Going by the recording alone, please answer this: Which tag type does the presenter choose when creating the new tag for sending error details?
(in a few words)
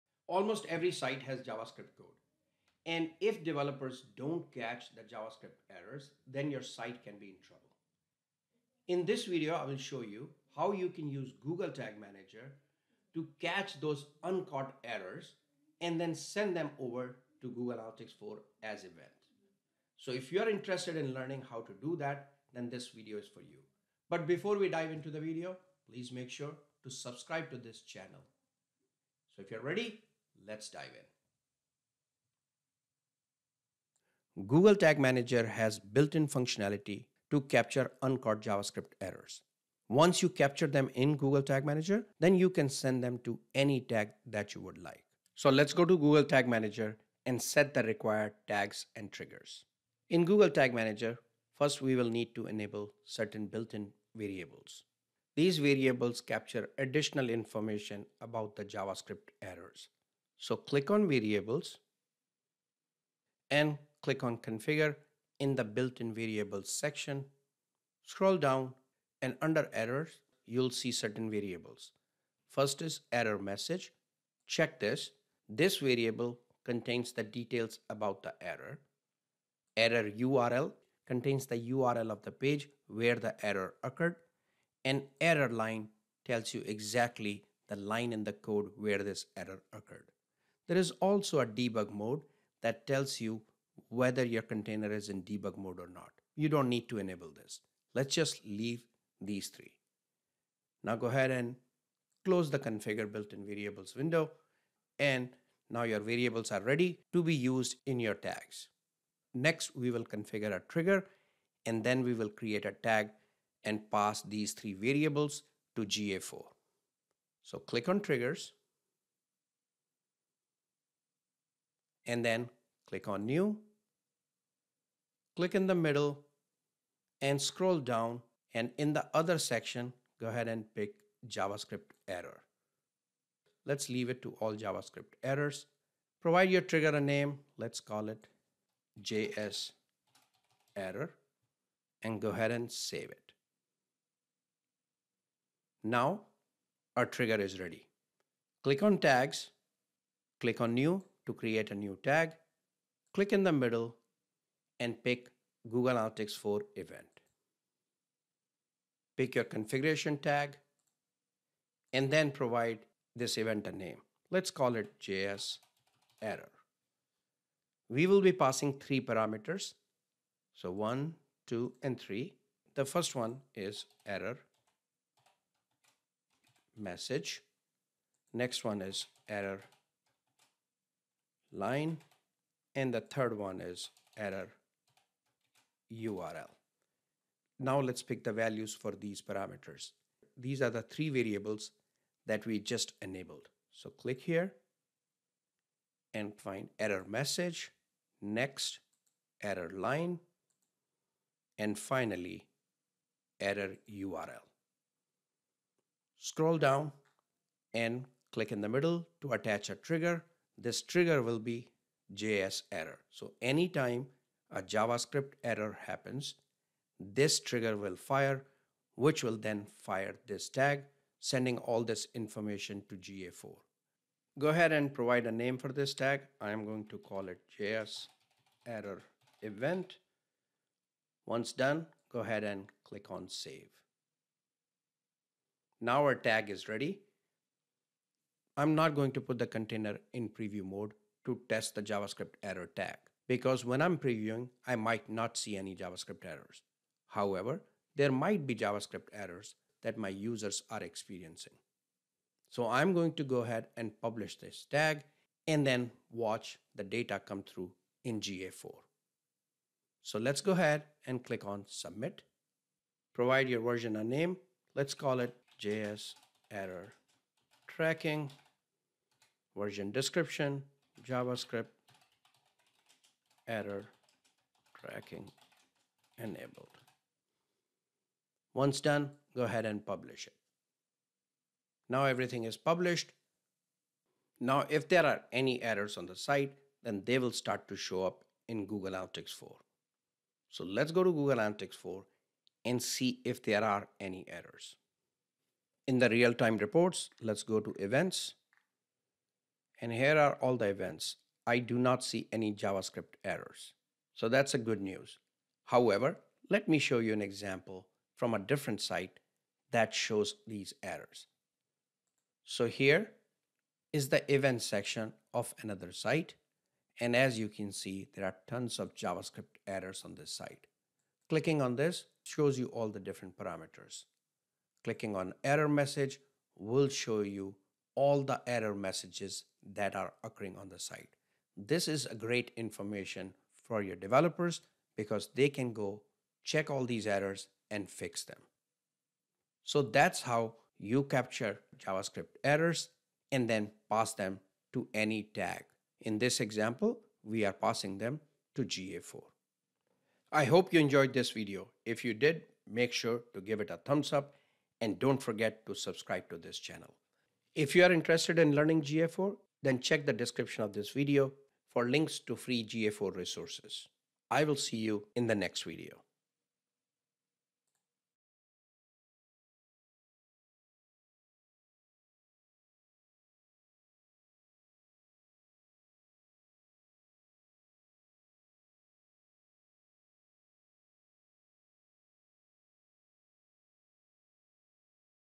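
Google Analytics 4 event.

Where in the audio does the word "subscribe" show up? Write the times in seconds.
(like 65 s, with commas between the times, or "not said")
26 s, 355 s.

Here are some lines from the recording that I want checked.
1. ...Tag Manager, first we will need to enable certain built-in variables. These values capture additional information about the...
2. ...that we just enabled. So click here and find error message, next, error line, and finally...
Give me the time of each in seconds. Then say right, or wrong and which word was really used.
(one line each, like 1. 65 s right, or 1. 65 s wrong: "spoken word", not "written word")
1. 50 s wrong: "variables", not "values"
2. 192 s right.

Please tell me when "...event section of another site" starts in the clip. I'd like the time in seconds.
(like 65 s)
314 s.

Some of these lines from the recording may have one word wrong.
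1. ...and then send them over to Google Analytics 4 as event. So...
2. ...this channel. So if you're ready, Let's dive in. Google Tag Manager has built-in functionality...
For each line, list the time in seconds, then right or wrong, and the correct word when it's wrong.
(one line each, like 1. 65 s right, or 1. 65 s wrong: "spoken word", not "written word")
1. 15 s right
2. 27 s right.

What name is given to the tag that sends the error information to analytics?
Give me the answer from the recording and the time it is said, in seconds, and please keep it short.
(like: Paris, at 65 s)
JS error event, at 227 s.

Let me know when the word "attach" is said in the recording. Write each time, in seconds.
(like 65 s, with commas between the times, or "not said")
209 s.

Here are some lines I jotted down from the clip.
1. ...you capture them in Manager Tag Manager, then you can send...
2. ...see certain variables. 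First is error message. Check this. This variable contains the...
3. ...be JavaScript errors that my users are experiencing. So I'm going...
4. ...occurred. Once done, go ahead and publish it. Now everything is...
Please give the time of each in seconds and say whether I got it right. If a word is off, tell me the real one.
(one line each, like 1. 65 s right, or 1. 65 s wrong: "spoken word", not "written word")
1. 40 s wrong: "Google", not "Manager"
2. 70 s right
3. 248 s right
4. 276 s wrong: "enabled", not "occurred".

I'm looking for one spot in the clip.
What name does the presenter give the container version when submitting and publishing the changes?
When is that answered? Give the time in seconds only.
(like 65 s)
265 s.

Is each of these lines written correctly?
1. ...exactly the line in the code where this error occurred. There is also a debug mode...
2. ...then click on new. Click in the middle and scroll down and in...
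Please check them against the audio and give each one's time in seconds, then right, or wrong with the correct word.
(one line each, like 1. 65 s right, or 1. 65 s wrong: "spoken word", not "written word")
1. 86 s right
2. 122 s right.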